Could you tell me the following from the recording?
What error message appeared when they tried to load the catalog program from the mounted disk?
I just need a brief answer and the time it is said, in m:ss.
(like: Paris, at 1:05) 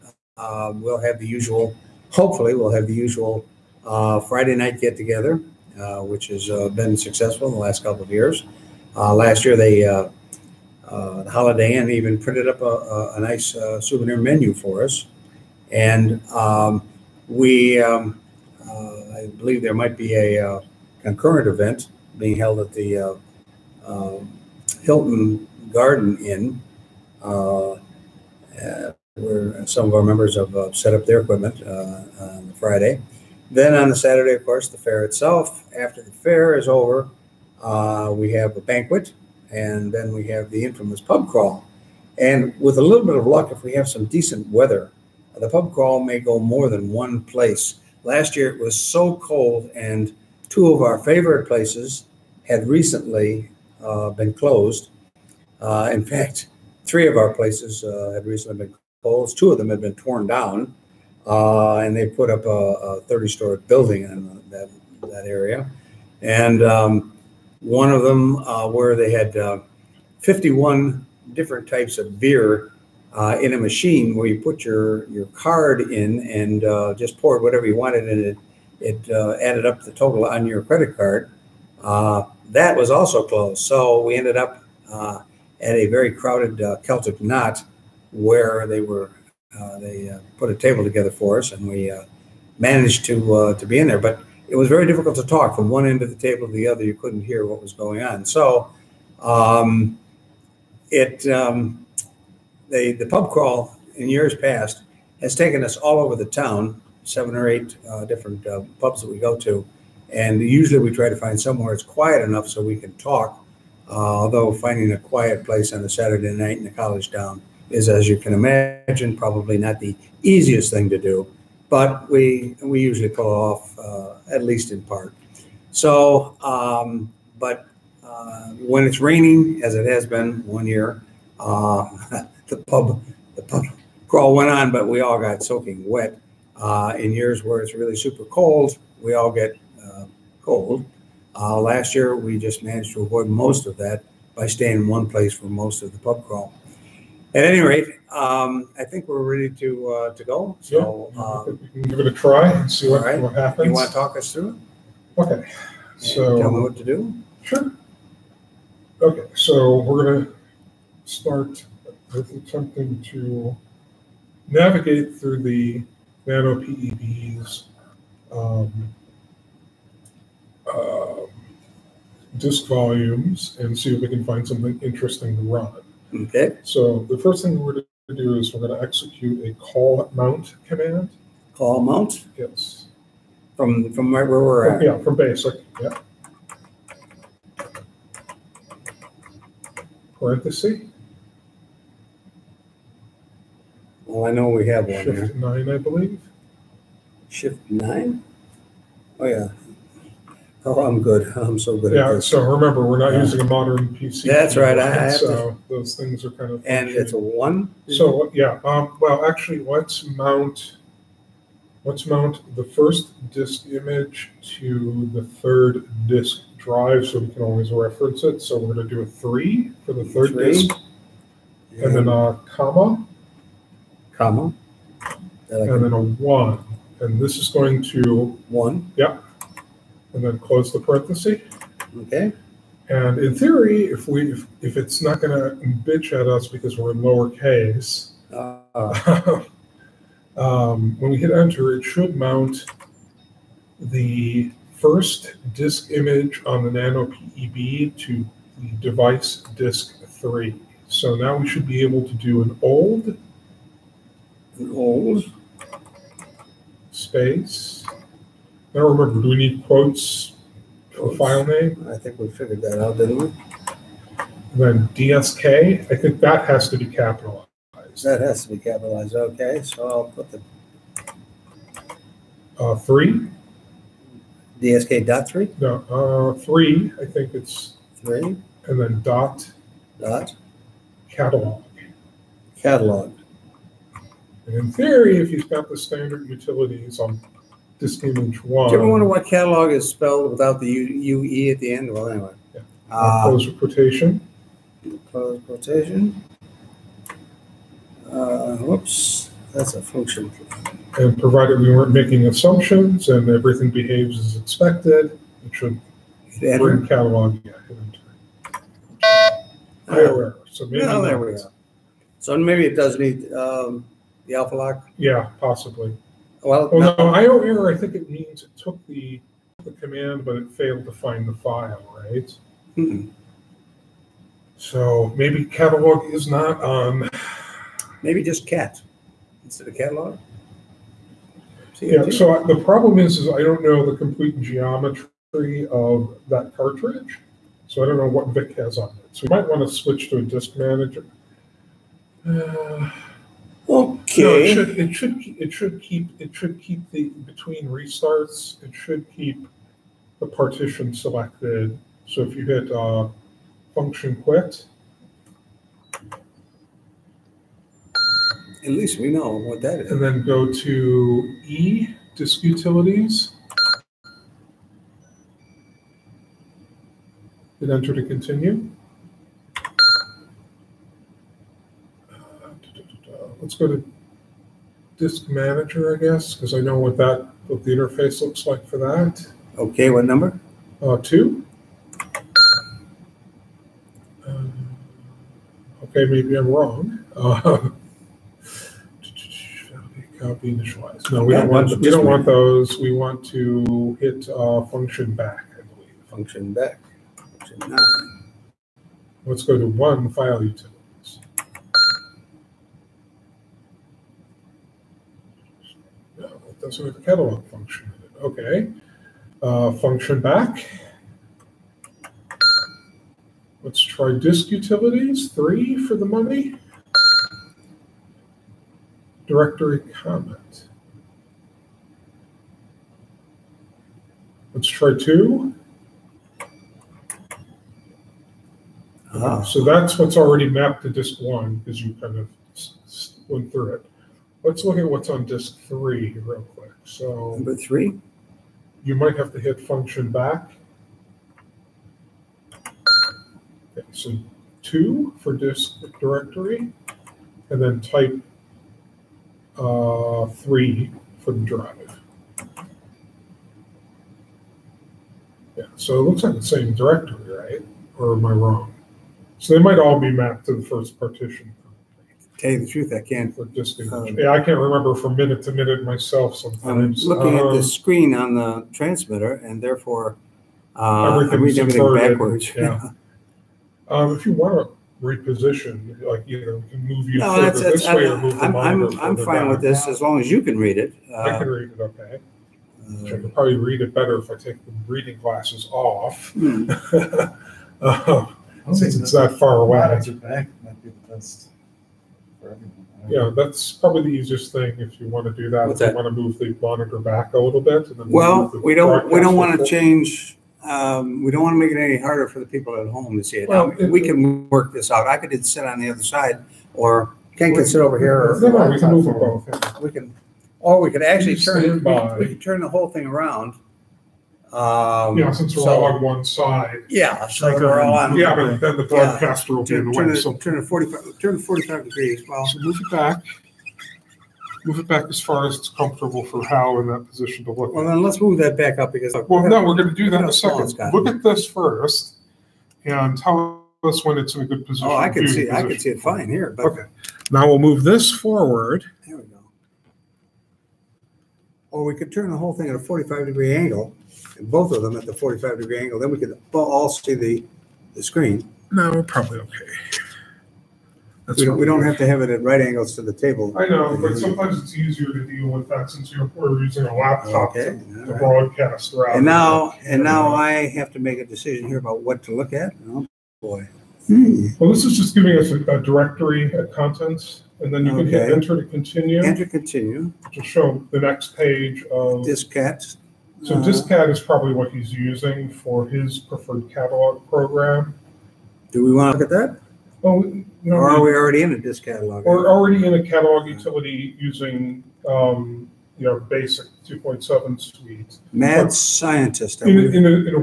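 IO error, at 5:17.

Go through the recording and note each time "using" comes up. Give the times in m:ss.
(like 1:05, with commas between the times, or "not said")
3:23, 9:16, 9:34, 9:44.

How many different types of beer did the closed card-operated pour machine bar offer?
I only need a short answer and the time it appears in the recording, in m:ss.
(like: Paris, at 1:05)
51, at 1:10.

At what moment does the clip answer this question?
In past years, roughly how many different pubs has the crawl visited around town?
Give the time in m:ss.
1:47.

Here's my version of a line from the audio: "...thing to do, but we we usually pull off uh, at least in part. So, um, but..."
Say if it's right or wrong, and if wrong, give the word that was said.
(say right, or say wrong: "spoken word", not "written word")
right.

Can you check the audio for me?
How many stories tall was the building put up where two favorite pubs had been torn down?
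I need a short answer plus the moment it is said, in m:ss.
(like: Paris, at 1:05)
30, at 1:03.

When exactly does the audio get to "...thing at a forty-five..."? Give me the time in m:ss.
9:02.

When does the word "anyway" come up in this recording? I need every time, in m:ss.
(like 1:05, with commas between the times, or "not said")
4:52.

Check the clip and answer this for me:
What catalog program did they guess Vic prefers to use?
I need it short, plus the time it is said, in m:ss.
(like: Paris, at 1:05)
Discat, at 9:33.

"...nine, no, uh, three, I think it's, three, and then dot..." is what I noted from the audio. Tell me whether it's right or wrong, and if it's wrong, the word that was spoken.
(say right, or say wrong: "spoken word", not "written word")
wrong: "three", not "nine".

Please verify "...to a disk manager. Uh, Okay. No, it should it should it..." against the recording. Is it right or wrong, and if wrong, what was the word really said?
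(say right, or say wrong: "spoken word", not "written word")
right.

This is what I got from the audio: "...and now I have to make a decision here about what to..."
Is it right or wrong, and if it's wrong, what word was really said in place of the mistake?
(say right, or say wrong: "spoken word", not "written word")
right.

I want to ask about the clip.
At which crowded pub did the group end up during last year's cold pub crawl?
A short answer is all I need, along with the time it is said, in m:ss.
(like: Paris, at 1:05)
Celtic Knot, at 1:26.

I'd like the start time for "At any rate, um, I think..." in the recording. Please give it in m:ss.
2:27.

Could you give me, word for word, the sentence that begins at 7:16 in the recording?
So number three, you might have to hit function back.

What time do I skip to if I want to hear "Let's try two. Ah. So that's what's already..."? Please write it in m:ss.
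7:04.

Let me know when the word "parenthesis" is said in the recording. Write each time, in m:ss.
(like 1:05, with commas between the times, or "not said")
3:10, 3:50.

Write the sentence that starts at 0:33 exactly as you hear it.
Then on the Saturday, of course, the fair itself.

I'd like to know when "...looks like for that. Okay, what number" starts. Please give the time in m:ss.
6:18.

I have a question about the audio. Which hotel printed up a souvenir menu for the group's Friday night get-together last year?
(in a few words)
Holiday Inn.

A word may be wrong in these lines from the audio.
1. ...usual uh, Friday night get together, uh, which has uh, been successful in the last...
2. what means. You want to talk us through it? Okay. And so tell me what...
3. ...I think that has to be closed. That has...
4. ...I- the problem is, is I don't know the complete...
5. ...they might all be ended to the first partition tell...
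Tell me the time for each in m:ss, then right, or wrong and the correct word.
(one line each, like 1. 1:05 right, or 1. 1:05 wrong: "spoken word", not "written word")
1. 0:02 right
2. 2:33 wrong: "happens", not "means"
3. 4:25 wrong: "capitalized", not "closed"
4. 5:32 right
5. 7:39 wrong: "mapped", not "ended".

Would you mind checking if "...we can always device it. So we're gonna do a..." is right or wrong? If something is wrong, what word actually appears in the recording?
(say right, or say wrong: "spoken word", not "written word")
wrong: "reference", not "device".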